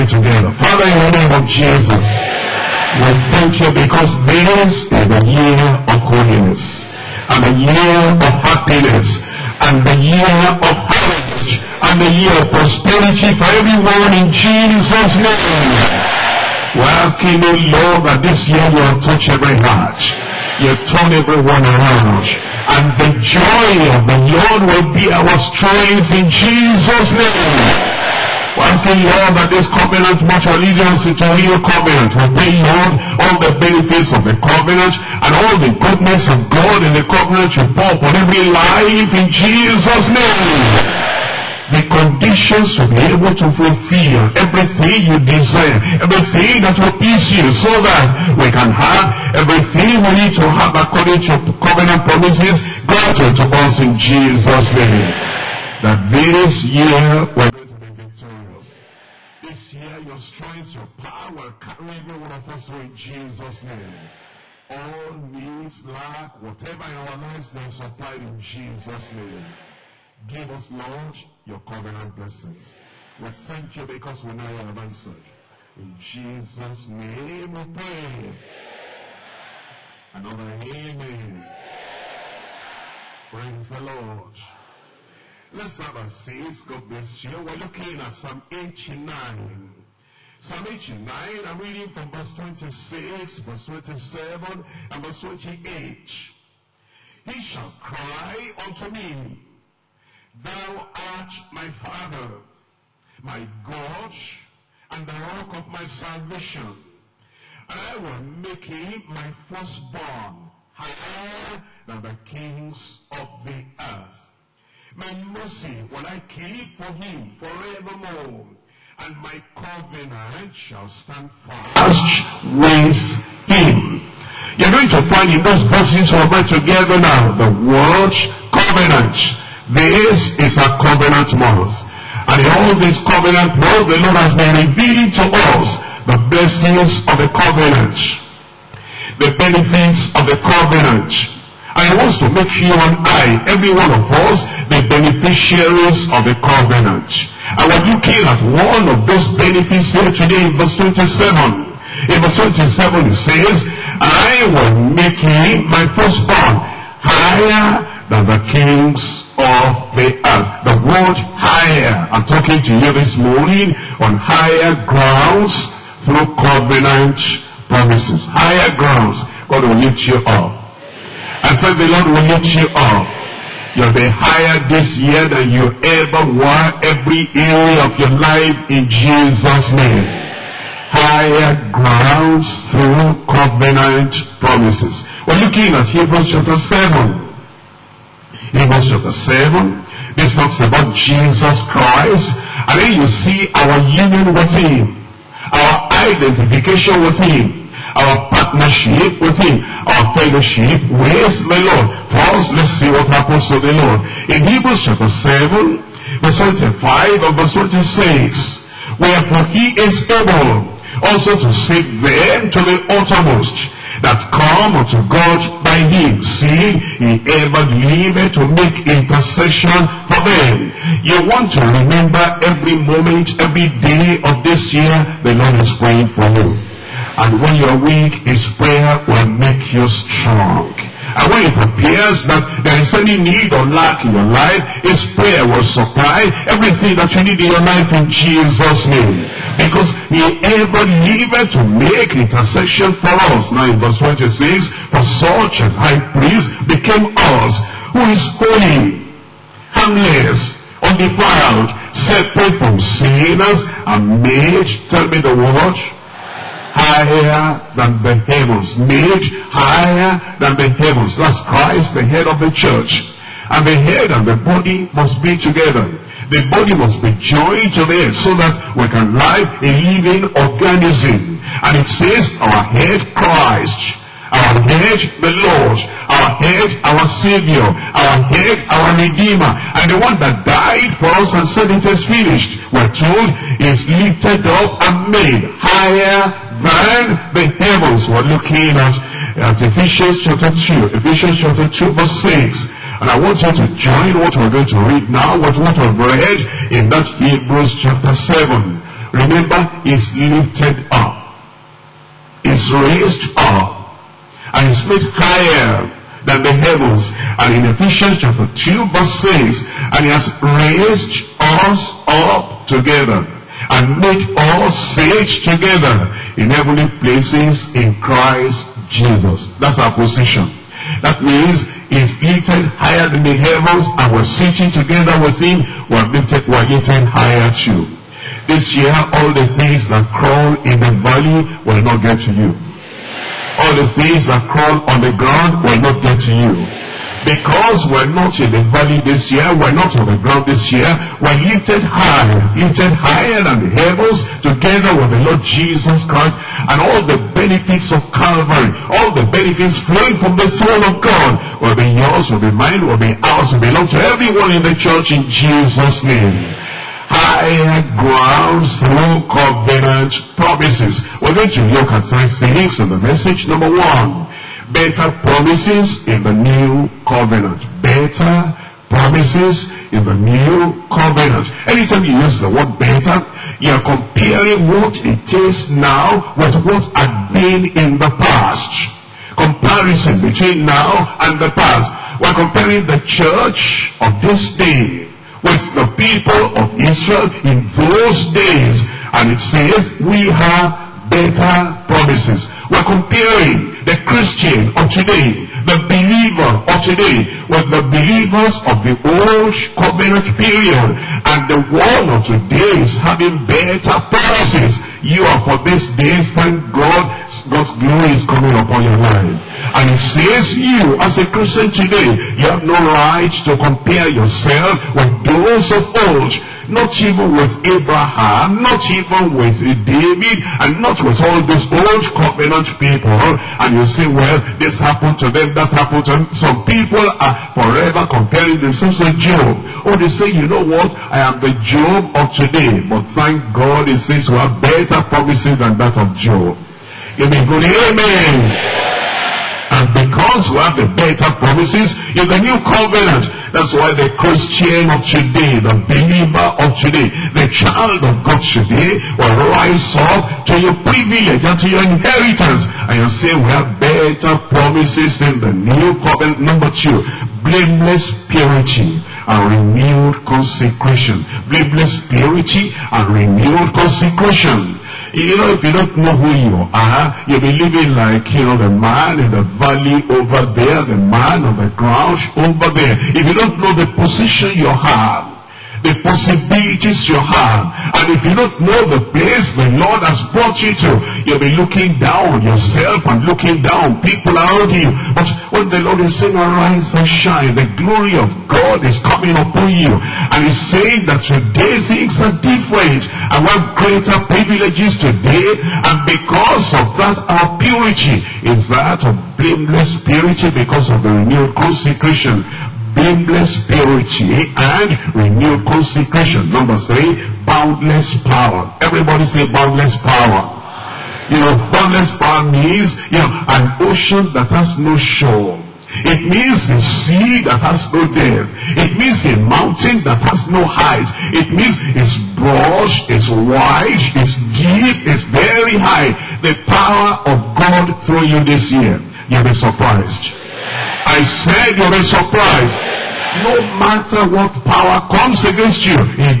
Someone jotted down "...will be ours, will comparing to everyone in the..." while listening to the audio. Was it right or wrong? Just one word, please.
wrong.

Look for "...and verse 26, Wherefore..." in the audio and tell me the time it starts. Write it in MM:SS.
03:27.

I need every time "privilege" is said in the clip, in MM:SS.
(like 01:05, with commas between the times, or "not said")
07:30, 08:14.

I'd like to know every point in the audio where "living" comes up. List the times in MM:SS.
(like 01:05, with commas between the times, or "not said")
04:29, 07:47.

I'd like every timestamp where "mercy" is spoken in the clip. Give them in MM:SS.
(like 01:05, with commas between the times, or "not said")
01:55.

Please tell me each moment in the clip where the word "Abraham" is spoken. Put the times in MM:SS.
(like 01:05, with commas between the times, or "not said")
06:57.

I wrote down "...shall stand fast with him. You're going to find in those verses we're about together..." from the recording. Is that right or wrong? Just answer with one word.
right.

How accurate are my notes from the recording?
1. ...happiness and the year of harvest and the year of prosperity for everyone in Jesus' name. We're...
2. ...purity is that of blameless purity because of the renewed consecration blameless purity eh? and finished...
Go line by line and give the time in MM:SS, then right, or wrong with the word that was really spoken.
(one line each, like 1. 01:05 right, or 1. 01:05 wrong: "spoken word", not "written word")
1. 00:08 right
2. 08:17 wrong: "renewed", not "finished".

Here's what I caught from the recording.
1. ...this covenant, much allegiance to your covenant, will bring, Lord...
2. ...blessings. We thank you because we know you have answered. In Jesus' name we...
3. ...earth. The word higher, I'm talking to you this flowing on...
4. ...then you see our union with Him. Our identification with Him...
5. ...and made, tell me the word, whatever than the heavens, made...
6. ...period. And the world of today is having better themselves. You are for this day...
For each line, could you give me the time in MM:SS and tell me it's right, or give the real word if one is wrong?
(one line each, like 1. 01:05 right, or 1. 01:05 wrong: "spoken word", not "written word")
1. 00:29 right
2. 01:12 right
3. 02:40 wrong: "morning", not "flowing"
4. 03:12 right
5. 04:13 wrong: "higher", not "whatever"
6. 06:40 wrong: "policies", not "themselves".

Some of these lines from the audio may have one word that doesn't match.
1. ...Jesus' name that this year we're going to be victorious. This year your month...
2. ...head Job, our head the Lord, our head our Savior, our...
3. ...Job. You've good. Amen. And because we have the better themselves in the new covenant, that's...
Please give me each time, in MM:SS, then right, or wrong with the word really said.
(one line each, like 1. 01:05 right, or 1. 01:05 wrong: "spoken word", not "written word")
1. 00:54 wrong: "strength", not "month"
2. 04:32 wrong: "Christ", not "Job"
3. 07:16 wrong: "promises", not "themselves".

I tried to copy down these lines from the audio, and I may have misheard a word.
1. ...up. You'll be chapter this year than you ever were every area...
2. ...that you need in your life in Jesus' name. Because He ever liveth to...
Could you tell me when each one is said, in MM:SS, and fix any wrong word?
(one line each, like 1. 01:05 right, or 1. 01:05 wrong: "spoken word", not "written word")
1. 02:52 wrong: "higher", not "chapter"
2. 03:57 right.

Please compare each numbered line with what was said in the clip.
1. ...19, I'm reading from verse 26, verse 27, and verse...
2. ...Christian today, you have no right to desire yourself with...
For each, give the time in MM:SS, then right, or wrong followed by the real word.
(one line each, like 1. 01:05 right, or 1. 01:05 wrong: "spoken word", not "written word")
1. 01:30 wrong: "89", not "19"
2. 06:51 wrong: "compare", not "desire".